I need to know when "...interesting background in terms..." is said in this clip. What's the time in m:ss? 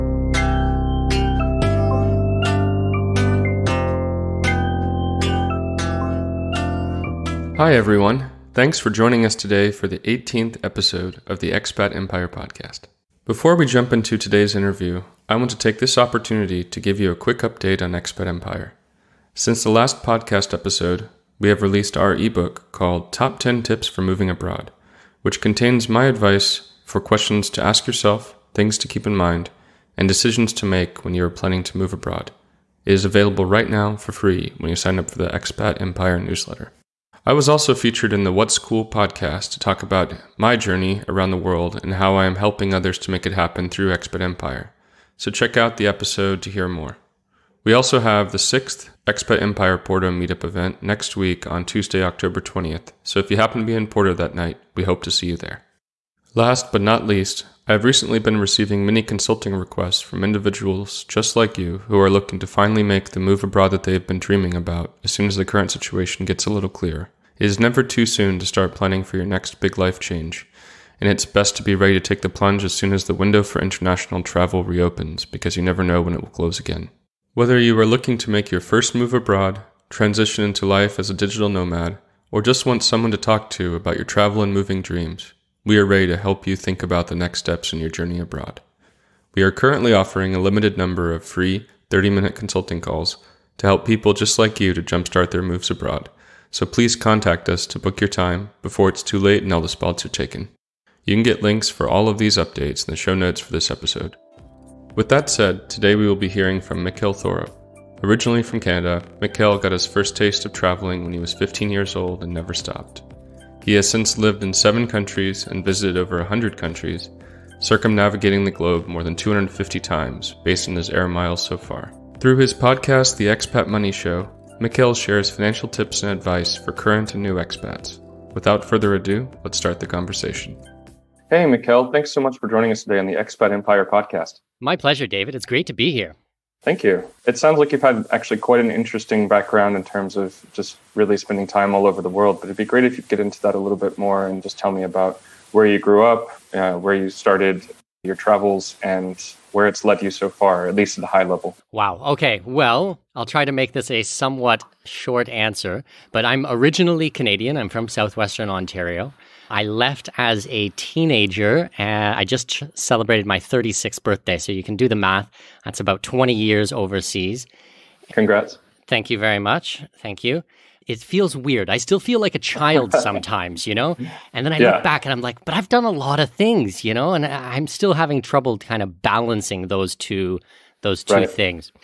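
2:18.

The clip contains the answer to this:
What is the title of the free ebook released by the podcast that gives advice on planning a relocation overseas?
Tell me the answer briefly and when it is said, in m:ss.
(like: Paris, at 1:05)
Top 10 Tips for Moving Abroad, at 0:23.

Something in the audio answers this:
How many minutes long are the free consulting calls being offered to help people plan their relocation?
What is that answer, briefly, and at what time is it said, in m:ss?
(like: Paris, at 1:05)
30, at 1:31.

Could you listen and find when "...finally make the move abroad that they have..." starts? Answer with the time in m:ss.
1:02.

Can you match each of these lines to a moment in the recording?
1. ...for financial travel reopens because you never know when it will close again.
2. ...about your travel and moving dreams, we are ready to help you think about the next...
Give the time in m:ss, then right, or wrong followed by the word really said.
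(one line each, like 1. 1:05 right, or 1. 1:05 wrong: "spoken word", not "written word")
1. 1:13 wrong: "international", not "financial"
2. 1:23 right.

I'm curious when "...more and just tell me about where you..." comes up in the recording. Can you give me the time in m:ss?
2:23.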